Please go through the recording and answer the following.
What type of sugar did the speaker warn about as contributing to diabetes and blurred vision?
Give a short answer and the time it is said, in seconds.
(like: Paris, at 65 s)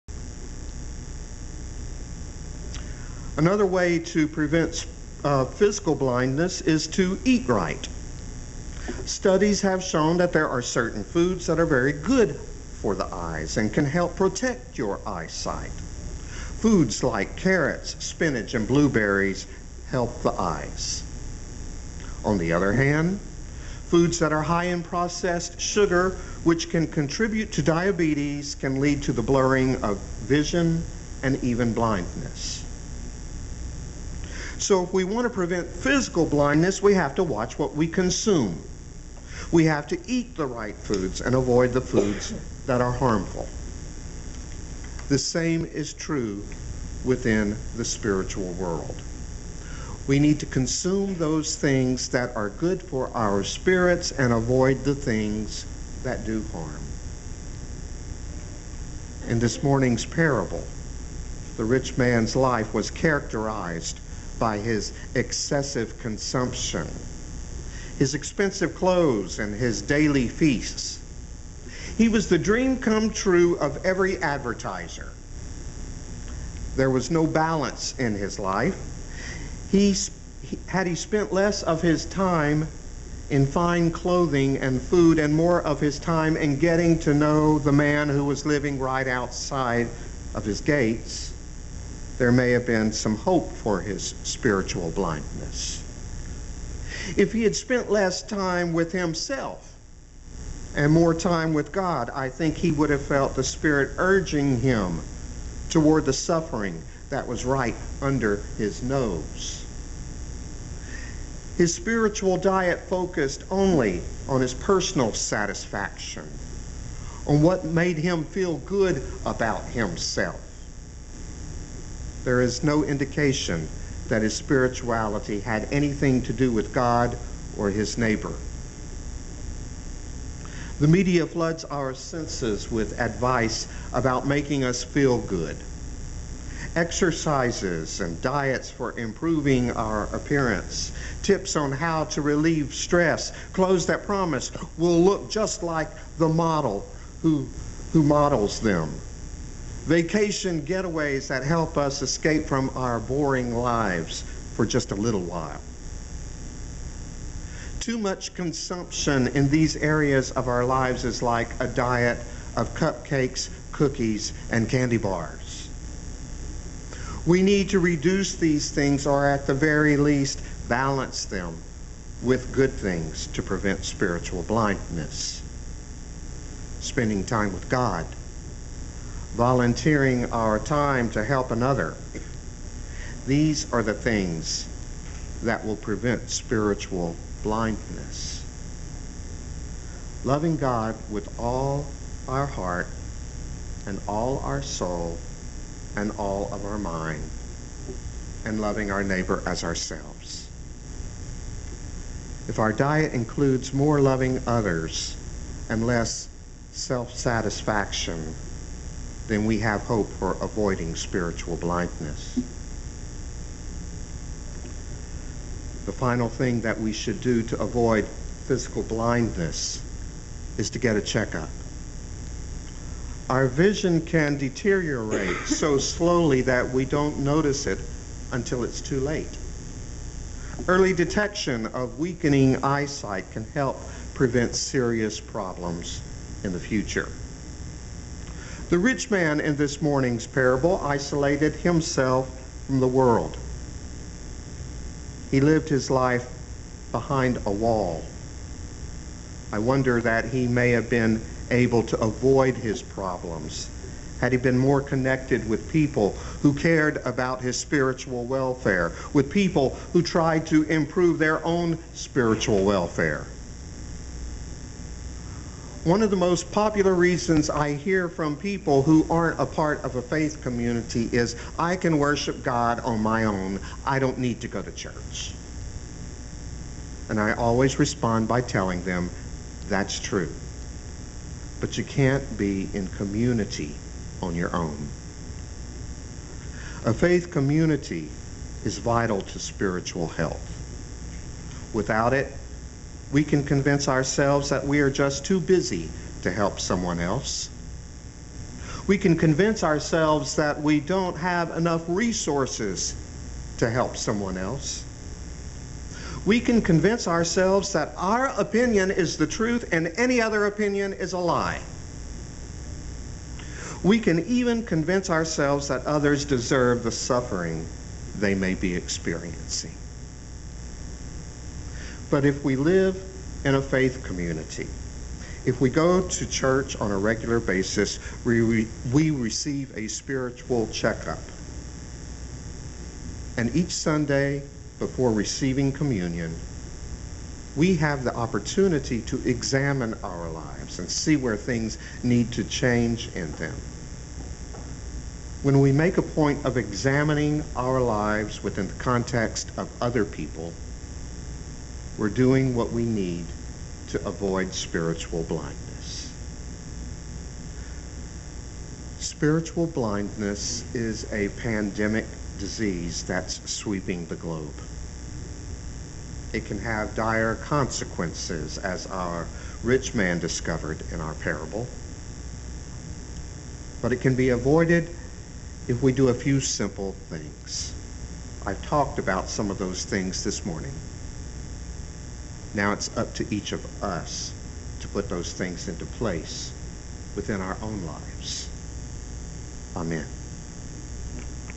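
processed sugar, at 24 s.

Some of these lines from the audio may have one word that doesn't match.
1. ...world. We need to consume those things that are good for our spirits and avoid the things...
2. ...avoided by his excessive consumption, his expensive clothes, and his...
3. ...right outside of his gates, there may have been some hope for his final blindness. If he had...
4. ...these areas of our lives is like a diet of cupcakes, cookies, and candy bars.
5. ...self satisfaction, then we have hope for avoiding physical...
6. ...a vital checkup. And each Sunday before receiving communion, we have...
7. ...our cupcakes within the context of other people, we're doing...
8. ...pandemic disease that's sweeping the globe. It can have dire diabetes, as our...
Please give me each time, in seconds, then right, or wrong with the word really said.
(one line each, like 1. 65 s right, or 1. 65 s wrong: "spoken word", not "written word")
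1. 48 s right
2. 62 s wrong: "characterized", not "avoided"
3. 88 s wrong: "spiritual", not "final"
4. 159 s right
5. 206 s wrong: "spiritual", not "physical"
6. 329 s wrong: "spiritual", not "vital"
7. 347 s wrong: "lives", not "cupcakes"
8. 361 s wrong: "consequences", not "diabetes".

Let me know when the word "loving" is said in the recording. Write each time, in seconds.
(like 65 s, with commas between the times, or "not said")
190 s, 198 s, 204 s.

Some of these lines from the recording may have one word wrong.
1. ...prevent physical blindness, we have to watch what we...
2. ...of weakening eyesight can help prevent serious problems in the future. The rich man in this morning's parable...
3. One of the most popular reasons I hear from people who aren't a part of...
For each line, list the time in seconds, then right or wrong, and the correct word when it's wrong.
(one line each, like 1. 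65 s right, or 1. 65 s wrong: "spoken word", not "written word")
1. 35 s right
2. 231 s right
3. 265 s right.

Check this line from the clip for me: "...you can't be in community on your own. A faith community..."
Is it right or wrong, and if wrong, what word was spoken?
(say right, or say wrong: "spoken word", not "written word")
right.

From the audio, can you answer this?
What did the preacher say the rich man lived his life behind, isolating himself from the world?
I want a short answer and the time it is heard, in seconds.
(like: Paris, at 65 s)
a wall, at 247 s.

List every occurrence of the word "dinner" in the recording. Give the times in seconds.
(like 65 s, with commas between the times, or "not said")
not said.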